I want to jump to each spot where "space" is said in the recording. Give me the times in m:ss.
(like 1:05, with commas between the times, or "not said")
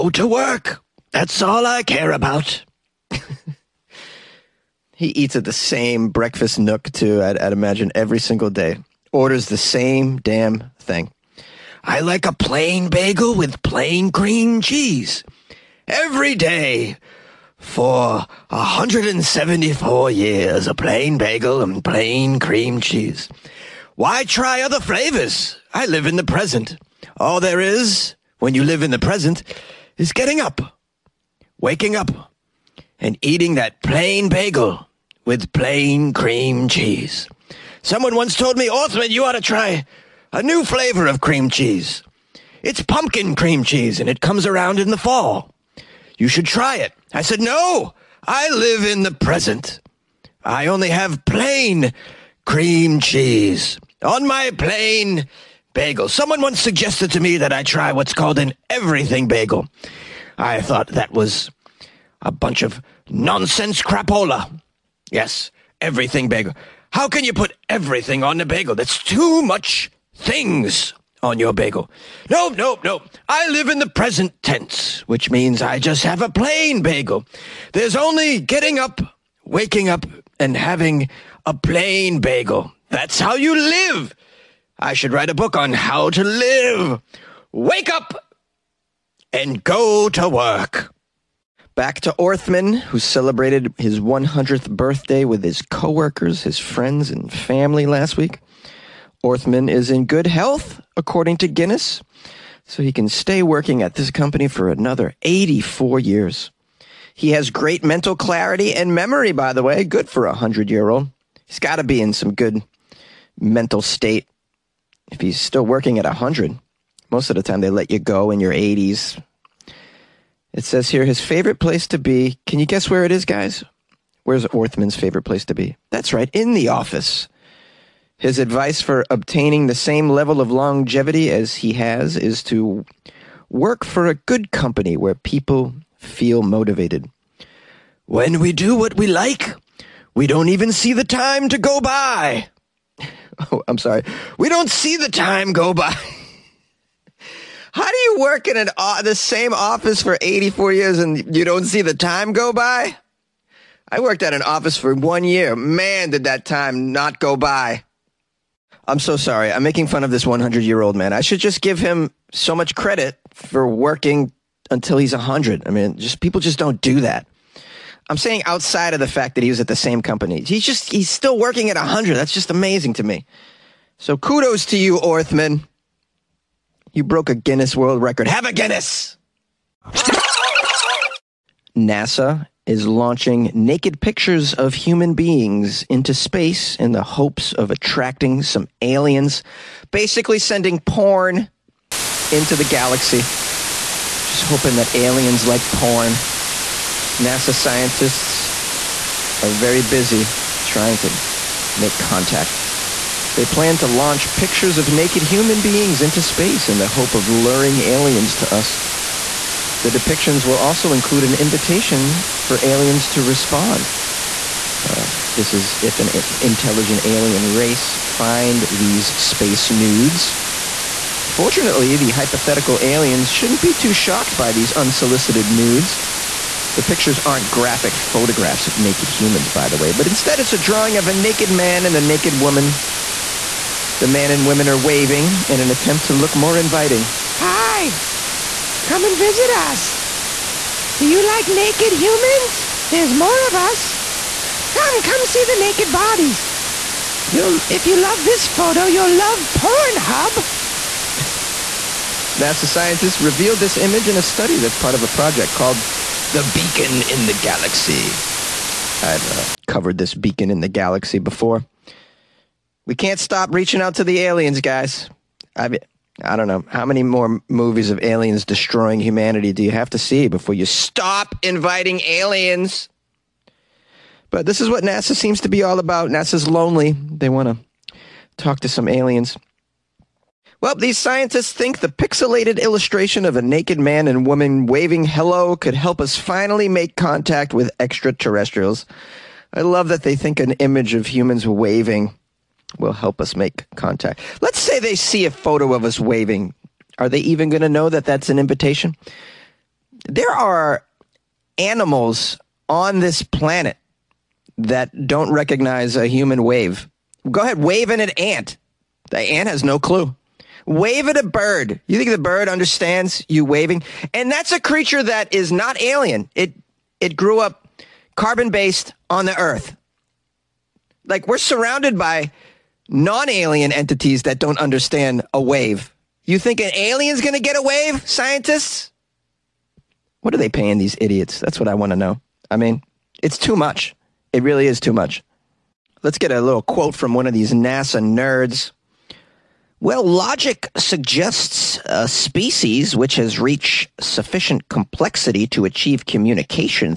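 3:06, 3:26, 3:39.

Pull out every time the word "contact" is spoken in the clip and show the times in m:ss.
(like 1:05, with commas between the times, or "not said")
3:21, 4:46, 4:53.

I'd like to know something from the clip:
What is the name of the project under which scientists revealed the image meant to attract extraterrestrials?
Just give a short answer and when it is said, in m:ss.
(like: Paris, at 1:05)
The Beacon in the Galaxy, at 4:16.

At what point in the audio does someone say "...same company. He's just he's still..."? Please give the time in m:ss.
2:49.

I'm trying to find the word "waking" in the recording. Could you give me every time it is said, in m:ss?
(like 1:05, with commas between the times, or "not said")
0:31, 1:19.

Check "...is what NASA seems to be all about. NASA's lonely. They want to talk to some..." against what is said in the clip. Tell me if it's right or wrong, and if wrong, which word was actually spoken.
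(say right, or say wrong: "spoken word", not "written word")
right.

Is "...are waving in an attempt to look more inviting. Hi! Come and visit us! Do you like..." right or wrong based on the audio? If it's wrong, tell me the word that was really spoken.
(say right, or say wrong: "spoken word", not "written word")
right.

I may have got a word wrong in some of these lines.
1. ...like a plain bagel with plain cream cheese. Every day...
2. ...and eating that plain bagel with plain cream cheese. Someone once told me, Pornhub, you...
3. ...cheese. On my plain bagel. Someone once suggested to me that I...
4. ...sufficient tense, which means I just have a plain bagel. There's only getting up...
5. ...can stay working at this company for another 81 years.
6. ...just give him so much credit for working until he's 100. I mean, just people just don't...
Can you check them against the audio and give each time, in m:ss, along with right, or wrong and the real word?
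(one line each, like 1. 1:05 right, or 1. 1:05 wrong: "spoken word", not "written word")
1. 0:12 right
2. 0:32 wrong: "Orthmann", not "Pornhub"
3. 0:52 right
4. 1:13 wrong: "present", not "sufficient"
5. 1:42 wrong: "84", not "81"
6. 2:41 right.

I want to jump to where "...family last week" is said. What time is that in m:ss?
1:37.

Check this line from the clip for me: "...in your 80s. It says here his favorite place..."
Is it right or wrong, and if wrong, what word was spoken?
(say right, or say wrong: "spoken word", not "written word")
right.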